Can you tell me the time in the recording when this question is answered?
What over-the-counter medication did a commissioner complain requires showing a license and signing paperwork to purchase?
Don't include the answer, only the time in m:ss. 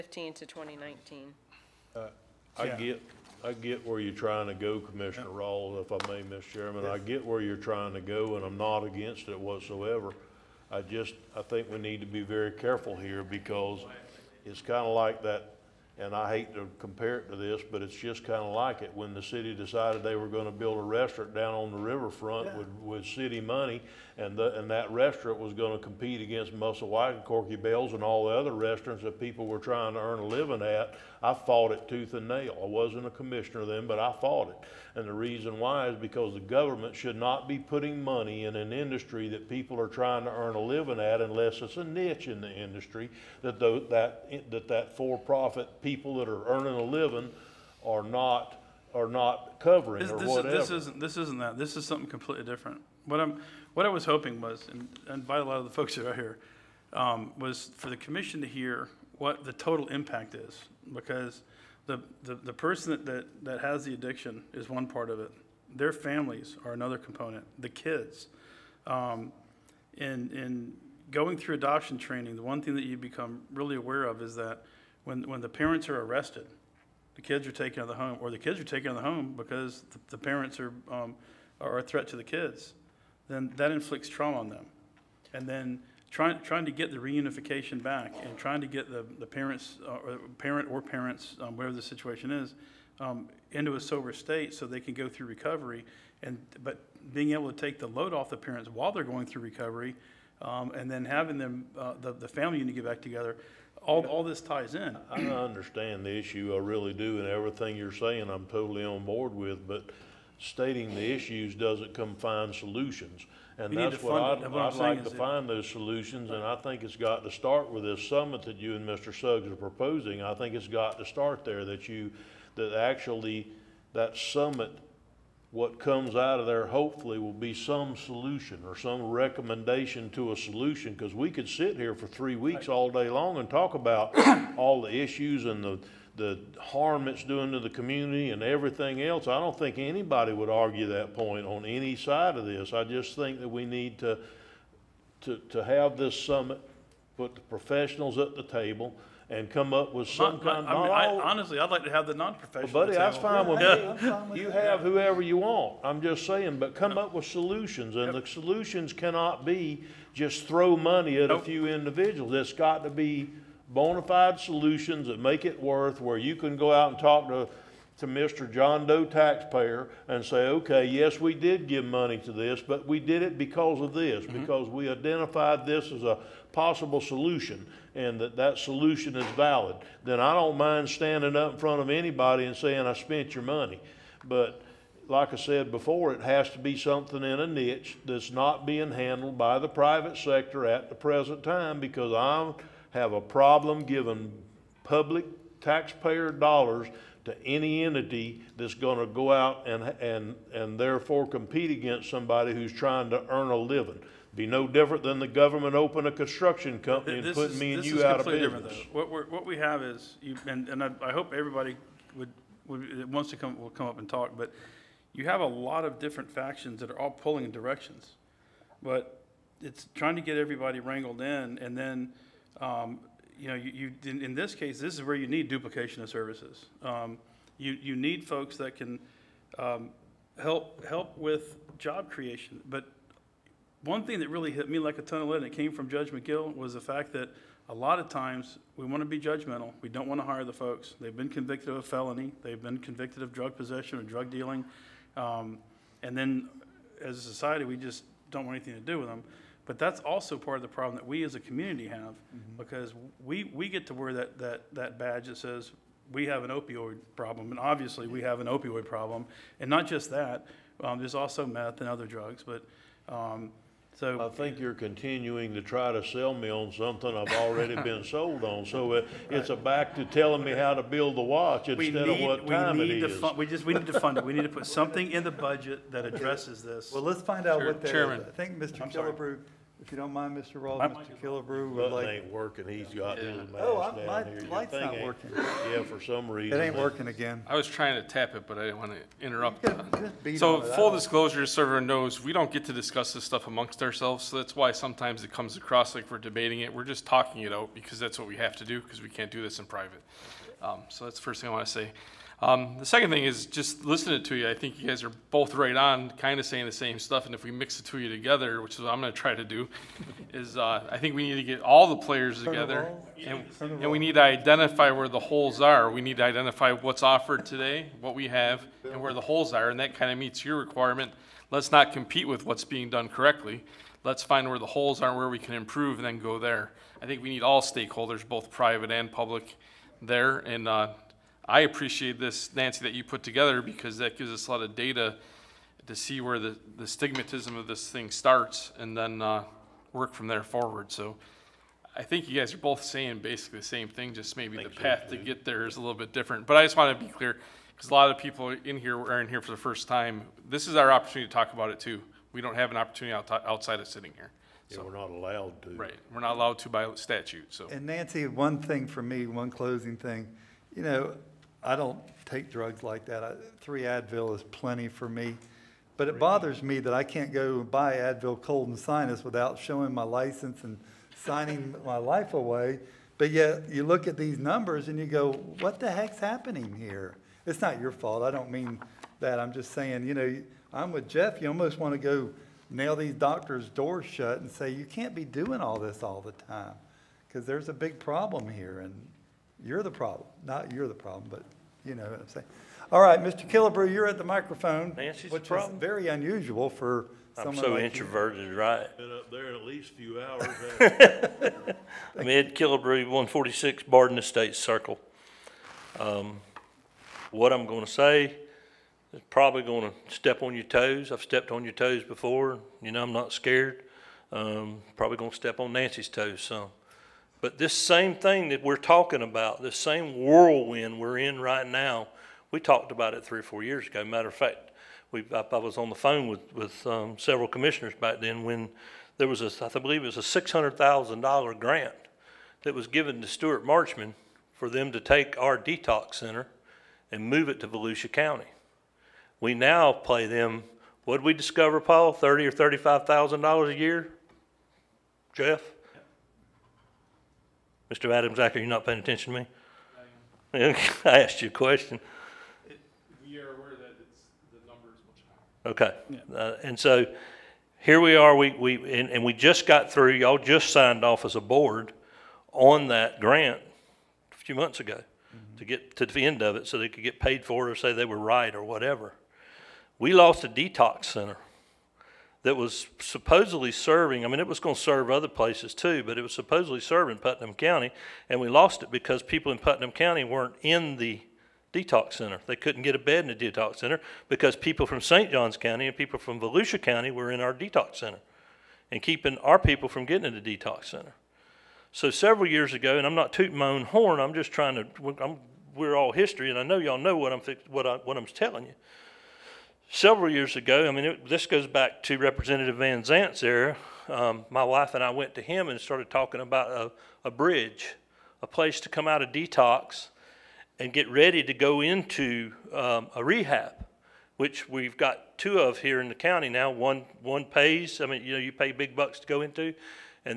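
6:07.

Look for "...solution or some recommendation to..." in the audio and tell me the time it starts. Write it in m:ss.
2:07.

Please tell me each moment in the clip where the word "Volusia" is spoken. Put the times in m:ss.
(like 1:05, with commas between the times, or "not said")
7:17, 8:06.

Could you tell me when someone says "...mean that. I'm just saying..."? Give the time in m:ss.
6:18.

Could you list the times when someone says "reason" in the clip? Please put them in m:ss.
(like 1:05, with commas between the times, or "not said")
0:35, 4:46.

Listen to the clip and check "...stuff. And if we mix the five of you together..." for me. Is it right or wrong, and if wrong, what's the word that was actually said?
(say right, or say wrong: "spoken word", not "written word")
wrong: "two", not "five".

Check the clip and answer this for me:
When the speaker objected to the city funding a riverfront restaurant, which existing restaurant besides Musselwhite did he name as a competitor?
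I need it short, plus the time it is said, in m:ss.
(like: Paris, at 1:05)
Corky Bells, at 0:27.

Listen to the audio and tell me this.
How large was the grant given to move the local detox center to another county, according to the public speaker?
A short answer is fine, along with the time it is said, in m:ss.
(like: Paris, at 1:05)
$600,000, at 7:10.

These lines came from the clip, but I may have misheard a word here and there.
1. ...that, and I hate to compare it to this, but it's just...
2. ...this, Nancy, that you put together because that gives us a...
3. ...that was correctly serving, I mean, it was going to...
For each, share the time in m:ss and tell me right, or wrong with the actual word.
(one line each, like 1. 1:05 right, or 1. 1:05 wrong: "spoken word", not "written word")
1. 0:15 right
2. 5:32 right
3. 7:52 wrong: "supposedly", not "correctly".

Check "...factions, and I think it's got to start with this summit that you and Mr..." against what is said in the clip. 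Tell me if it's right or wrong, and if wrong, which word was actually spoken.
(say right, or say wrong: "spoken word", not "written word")
wrong: "solutions", not "factions".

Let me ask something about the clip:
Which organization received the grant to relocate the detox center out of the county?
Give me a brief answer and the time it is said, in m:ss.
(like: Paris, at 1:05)
Stewart Marchman, at 7:13.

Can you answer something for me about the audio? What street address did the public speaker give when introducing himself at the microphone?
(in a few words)
146 Barden Estates Circle.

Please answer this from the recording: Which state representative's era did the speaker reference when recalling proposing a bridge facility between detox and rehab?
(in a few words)
Representative Van Zant.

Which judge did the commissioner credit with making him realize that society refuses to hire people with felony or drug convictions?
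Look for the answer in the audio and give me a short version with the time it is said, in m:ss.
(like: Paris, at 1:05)
Judge McGill, at 3:55.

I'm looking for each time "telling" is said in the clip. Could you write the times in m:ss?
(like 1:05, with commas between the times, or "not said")
4:30, 8:18.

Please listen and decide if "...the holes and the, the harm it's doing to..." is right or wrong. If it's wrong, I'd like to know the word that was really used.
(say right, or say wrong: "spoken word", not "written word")
wrong: "issues", not "holes".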